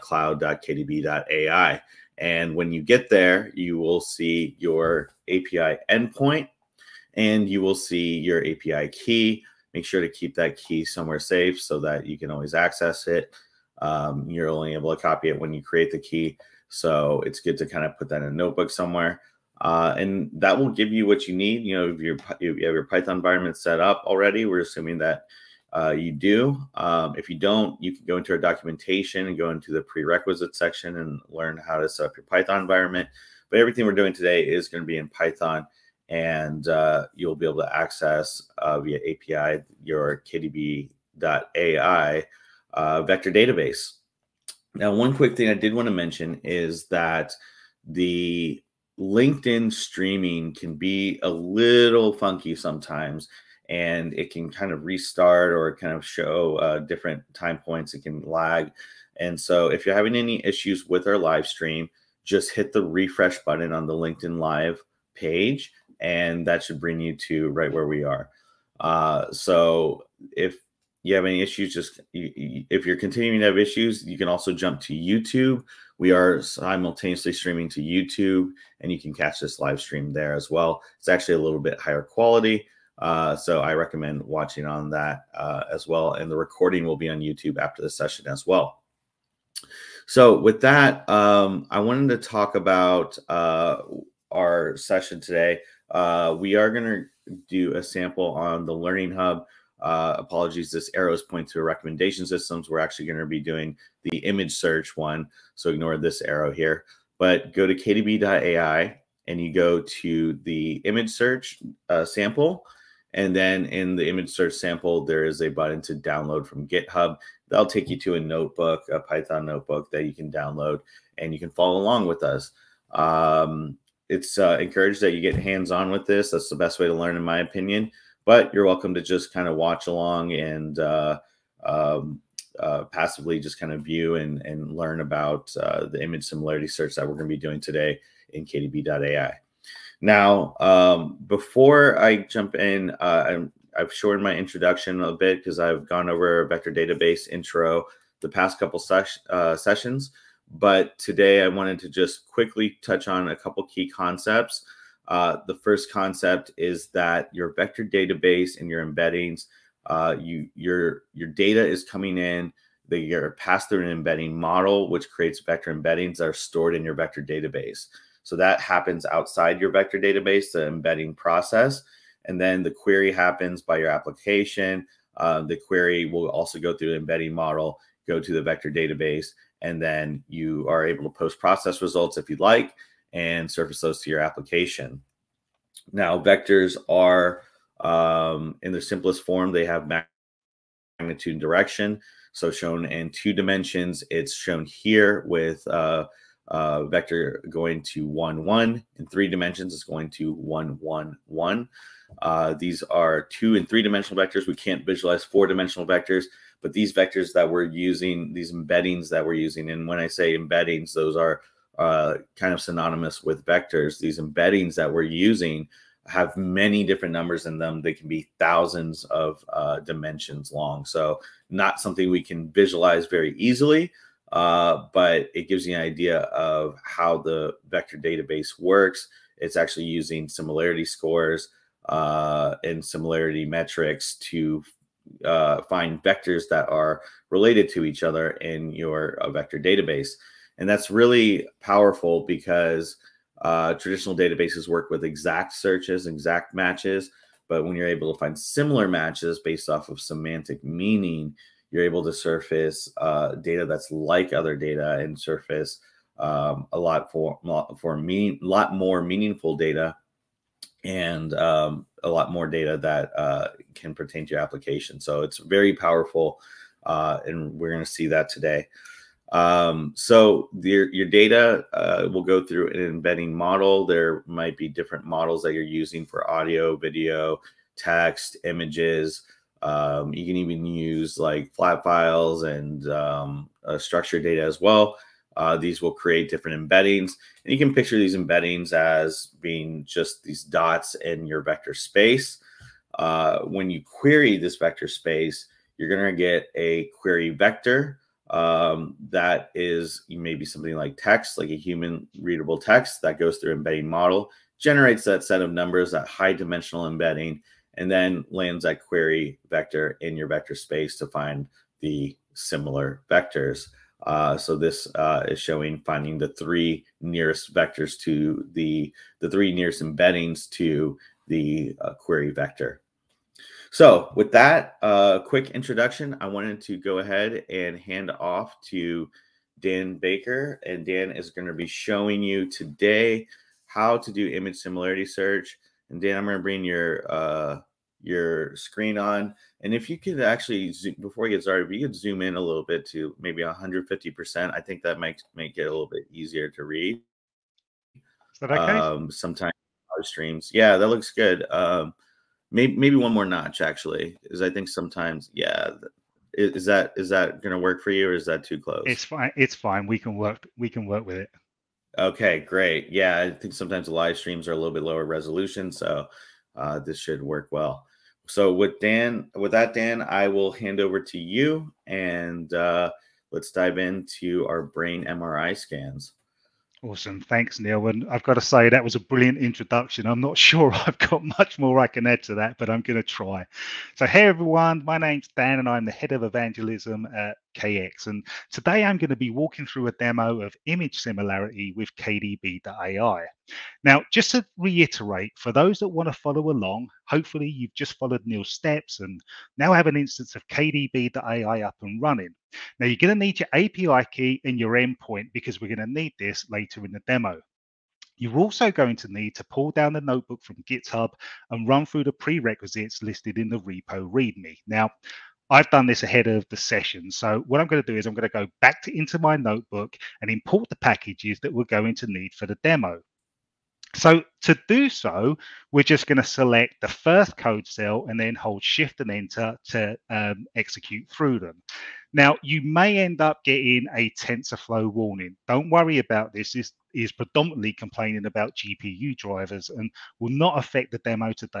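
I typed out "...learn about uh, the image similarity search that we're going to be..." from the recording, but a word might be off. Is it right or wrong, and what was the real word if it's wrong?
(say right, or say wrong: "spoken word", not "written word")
right.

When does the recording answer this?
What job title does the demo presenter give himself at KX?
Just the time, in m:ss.
6:25.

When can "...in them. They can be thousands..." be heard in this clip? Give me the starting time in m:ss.
3:37.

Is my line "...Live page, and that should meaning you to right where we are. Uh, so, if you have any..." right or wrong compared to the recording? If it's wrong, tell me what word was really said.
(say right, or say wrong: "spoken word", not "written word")
wrong: "bring", not "meaning".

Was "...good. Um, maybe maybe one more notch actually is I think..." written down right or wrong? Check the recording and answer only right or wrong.
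right.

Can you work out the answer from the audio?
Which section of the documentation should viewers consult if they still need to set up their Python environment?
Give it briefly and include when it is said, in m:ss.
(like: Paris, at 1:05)
prerequisite section, at 0:29.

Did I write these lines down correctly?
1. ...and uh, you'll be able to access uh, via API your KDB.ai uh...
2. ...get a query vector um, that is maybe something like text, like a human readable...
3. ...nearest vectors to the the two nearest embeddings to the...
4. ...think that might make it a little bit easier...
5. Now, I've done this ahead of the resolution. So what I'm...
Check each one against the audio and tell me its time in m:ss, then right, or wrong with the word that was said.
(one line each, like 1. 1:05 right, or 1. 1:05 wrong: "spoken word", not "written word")
1. 0:36 right
2. 4:56 right
3. 5:17 wrong: "three", not "two"
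4. 5:44 right
5. 6:54 wrong: "session", not "resolution".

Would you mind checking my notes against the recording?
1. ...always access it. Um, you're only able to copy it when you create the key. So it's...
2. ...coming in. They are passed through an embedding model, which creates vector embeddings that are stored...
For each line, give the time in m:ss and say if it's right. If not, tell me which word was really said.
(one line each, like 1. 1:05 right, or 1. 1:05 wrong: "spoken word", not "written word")
1. 0:12 right
2. 2:41 right.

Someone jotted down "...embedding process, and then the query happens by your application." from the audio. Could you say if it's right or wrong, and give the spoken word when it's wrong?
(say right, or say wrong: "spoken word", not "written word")
right.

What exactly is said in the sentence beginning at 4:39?
Um, you can even use like flat files and um, uh, structured data as well.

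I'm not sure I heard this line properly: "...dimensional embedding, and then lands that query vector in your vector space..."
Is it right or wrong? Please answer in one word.
right.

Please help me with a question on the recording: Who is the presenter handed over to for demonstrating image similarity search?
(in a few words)
Dan Baker.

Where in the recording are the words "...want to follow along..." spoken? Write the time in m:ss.
6:35.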